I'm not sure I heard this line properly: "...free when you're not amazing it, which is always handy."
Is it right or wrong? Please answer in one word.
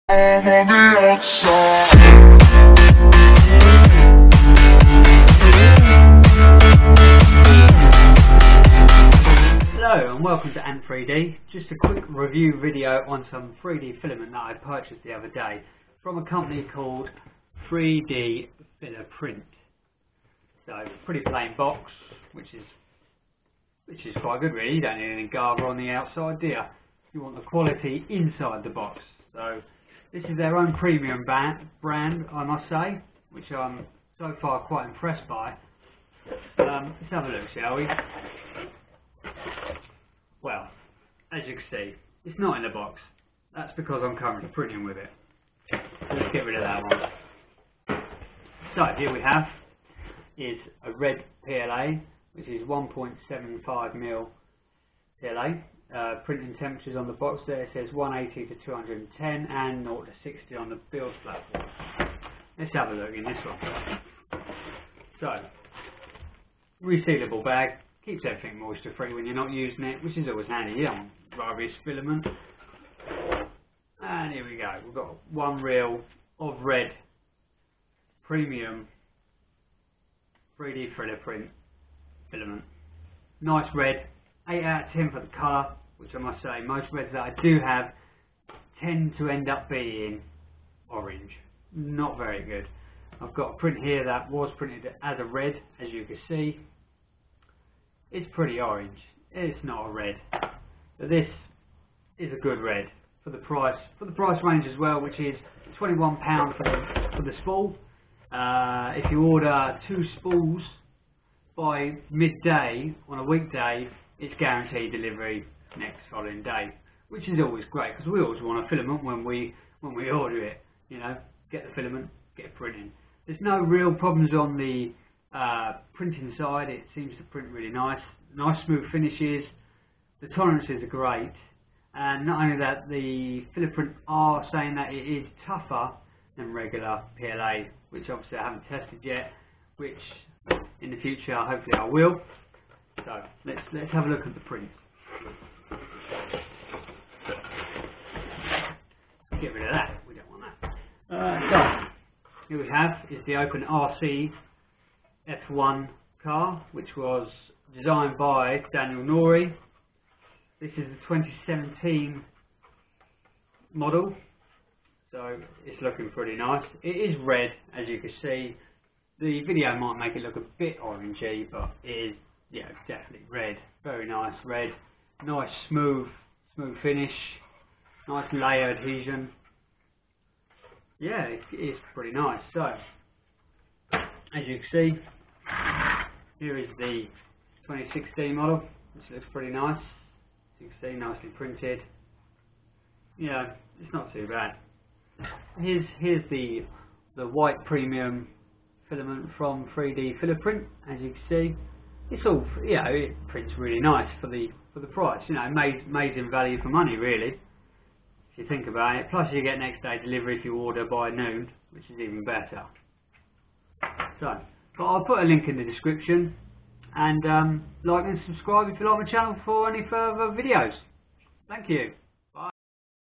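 wrong.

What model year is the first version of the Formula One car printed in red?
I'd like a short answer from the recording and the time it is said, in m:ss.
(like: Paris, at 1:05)
2017, at 2:41.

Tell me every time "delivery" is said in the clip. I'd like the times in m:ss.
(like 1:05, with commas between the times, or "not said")
1:54, 3:30.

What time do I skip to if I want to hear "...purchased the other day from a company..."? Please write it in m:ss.
0:14.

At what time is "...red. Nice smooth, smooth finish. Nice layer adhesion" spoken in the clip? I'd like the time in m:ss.
2:54.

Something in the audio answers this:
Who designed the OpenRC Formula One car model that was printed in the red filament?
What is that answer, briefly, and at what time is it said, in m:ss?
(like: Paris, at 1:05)
Daniel Noree, at 2:38.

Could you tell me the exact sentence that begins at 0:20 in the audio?
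So pretty plain box, which is which is quite good really.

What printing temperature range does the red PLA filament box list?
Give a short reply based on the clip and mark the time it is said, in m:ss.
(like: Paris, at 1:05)
180 to 210, at 0:57.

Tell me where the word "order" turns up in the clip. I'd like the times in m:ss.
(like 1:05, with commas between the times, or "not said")
1:49, 2:00, 3:30.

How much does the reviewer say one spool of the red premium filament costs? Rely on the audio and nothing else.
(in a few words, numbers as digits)
£21.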